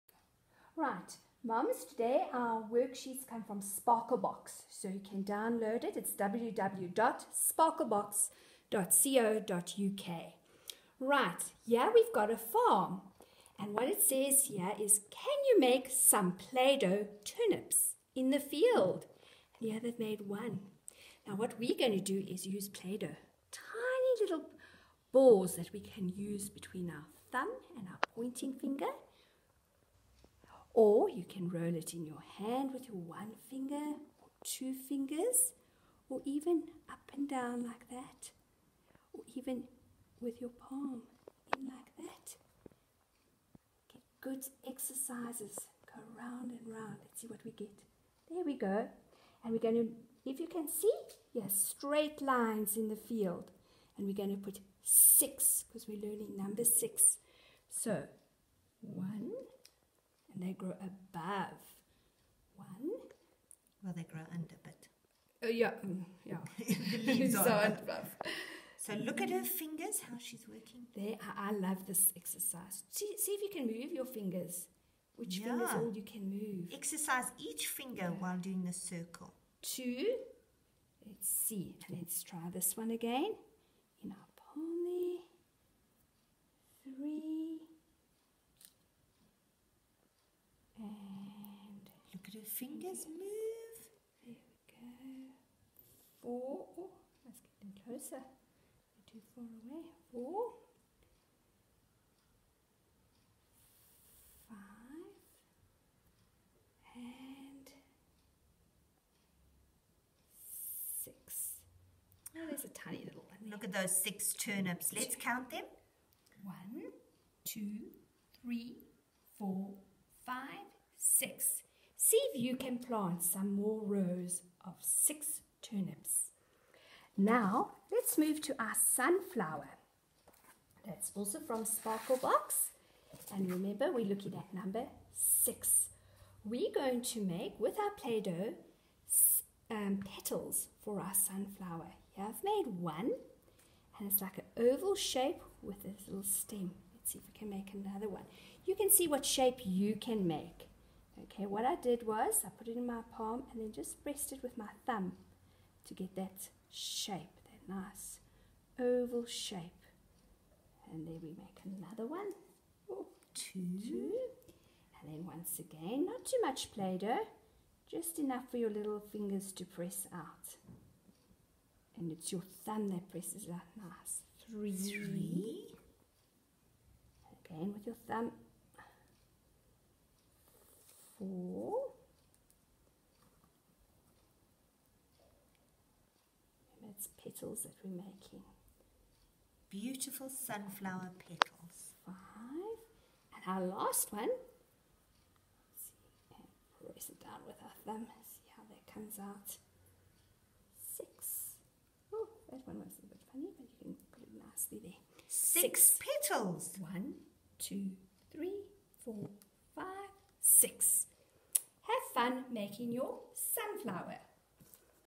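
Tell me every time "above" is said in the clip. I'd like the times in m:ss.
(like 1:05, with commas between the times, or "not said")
1:00, 1:07.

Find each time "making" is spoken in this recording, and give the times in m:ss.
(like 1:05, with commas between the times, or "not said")
3:07, 3:32.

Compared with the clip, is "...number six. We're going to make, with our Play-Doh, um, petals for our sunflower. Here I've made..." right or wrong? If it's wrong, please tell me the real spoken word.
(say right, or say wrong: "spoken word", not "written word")
right.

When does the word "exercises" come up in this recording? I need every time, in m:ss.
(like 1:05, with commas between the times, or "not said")
0:44, 1:12, 1:16.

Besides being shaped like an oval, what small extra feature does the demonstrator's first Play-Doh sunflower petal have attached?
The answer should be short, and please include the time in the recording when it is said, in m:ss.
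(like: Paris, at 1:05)
A little stem, at 2:26.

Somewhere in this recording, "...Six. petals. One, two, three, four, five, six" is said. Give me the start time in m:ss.
3:25.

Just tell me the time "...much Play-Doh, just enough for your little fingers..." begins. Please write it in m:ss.
2:46.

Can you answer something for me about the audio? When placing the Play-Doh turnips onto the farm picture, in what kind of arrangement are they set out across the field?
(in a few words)
Straight lines.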